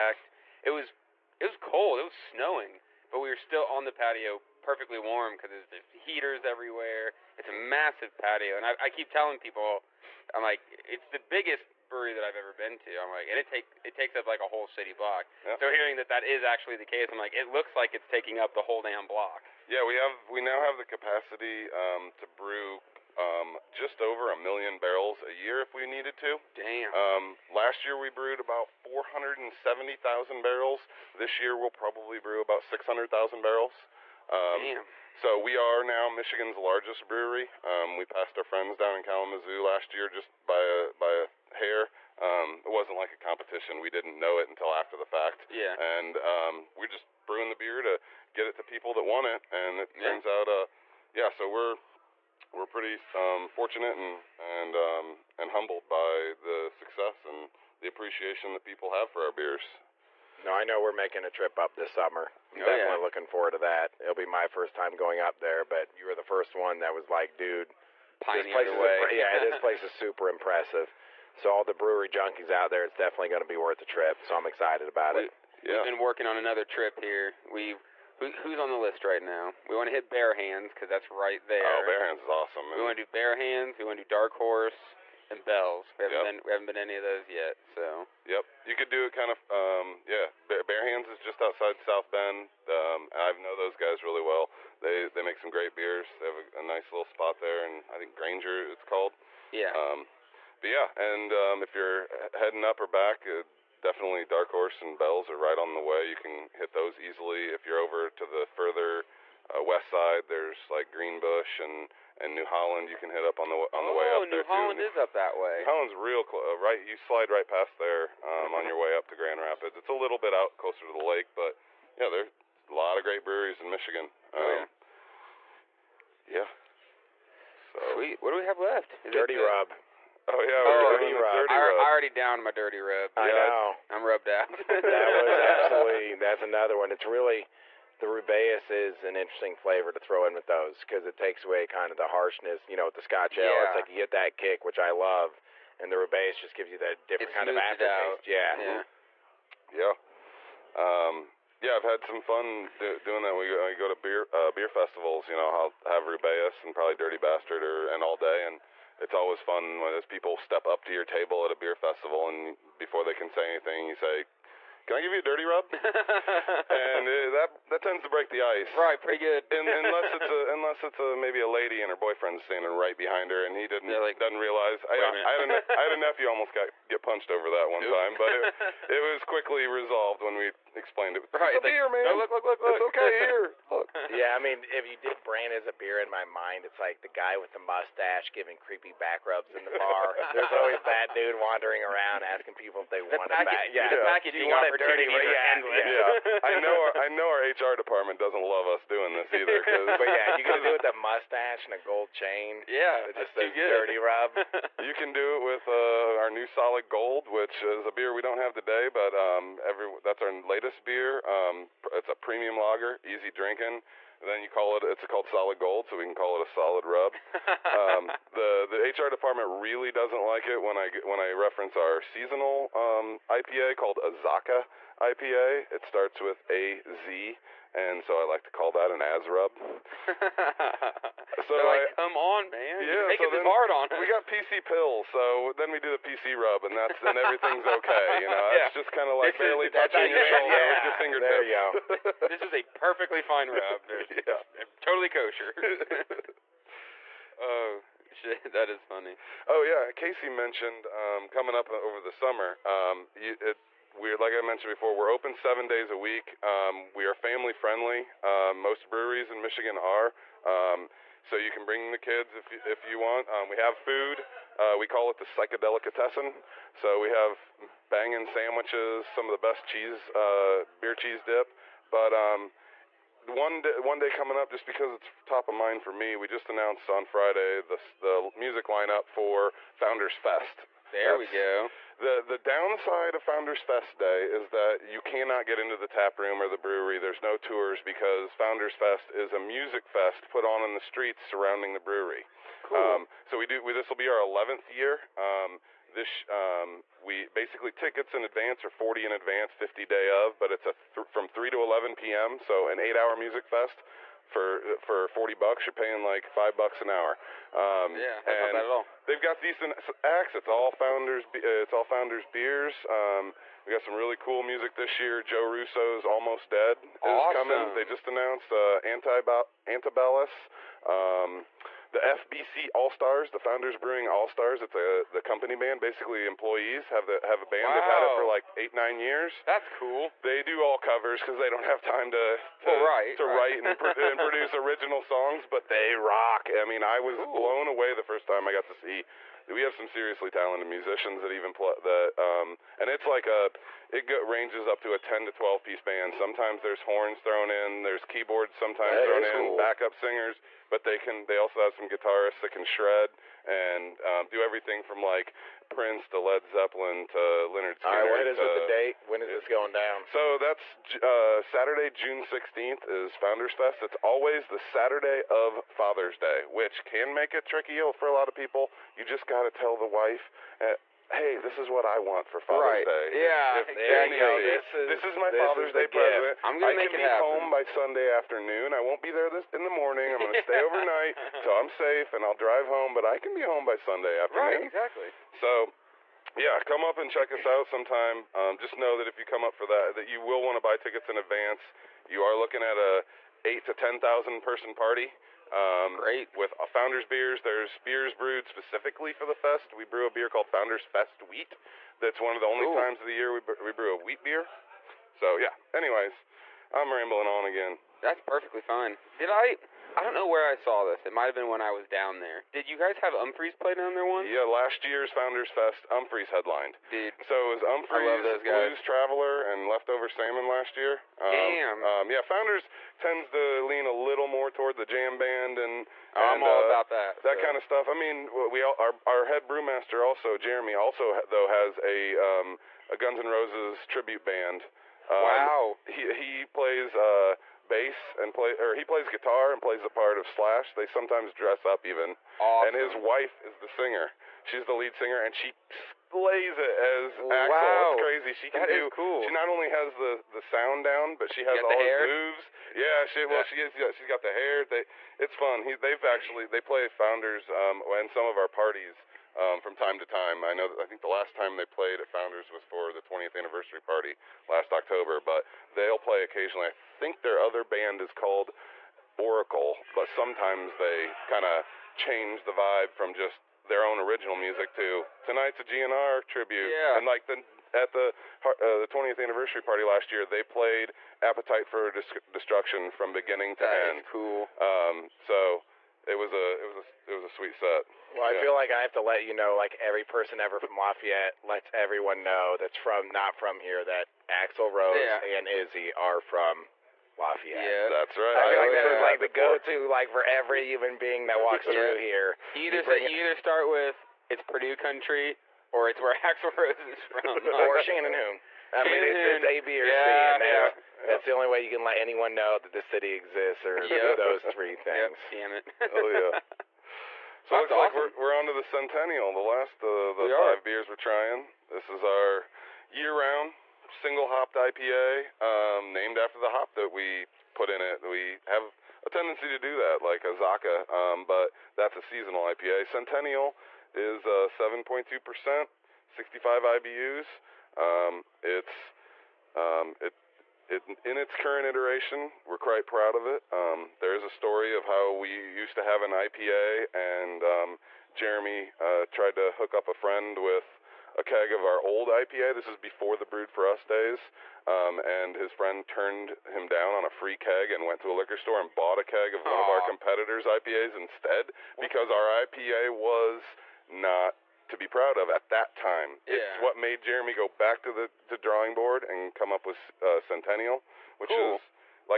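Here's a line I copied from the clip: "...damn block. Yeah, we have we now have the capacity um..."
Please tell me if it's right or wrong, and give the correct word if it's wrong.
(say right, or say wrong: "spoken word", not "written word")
right.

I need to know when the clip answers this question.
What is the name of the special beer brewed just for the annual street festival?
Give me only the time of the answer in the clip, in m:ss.
6:40.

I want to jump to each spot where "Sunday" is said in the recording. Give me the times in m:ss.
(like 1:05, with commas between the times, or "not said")
6:17, 6:23.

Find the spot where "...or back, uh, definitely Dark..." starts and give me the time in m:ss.
1:42.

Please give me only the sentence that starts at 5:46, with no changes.
Sometimes there's horns thrown in, there's keyboards sometimes that thrown in, cool.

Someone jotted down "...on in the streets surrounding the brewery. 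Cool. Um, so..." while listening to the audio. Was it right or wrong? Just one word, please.
right.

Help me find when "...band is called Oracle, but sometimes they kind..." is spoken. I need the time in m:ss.
7:47.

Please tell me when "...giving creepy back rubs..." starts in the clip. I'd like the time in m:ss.
3:08.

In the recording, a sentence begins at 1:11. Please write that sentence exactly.
So all the brewery junkies out there, it's definitely going to be worth the trip.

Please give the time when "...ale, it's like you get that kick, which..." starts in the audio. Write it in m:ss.
2:23.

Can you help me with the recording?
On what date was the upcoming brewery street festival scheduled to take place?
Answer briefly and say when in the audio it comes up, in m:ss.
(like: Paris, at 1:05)
Saturday, June 16th, at 6:01.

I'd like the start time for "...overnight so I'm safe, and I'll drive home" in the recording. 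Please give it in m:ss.
6:20.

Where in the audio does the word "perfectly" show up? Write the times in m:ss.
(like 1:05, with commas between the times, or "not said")
0:04, 4:02, 6:48.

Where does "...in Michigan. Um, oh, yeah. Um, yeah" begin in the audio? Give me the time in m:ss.
2:03.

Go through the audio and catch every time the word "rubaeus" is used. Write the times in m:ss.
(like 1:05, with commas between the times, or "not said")
2:18, 2:25, 2:36.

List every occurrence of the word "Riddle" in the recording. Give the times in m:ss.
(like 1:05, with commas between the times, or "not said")
not said.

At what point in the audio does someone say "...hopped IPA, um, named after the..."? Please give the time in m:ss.
8:44.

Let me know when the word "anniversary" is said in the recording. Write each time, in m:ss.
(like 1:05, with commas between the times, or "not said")
7:43, 7:59.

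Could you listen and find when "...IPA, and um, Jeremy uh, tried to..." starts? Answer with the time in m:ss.
9:06.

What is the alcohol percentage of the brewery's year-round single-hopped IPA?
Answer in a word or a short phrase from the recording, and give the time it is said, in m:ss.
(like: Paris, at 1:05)
7.2%, at 8:54.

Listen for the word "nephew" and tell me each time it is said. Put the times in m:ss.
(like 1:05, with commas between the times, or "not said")
2:55.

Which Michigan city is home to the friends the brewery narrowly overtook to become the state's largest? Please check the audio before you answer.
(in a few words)
Kalamazoo.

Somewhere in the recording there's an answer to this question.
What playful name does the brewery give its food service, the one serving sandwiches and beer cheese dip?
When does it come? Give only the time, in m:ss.
4:25.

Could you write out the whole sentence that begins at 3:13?
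Yeah, the packaging opportunities dirty, are yeah.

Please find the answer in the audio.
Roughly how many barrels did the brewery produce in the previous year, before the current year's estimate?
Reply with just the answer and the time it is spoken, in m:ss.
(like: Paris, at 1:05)
470,000 barrels, at 0:28.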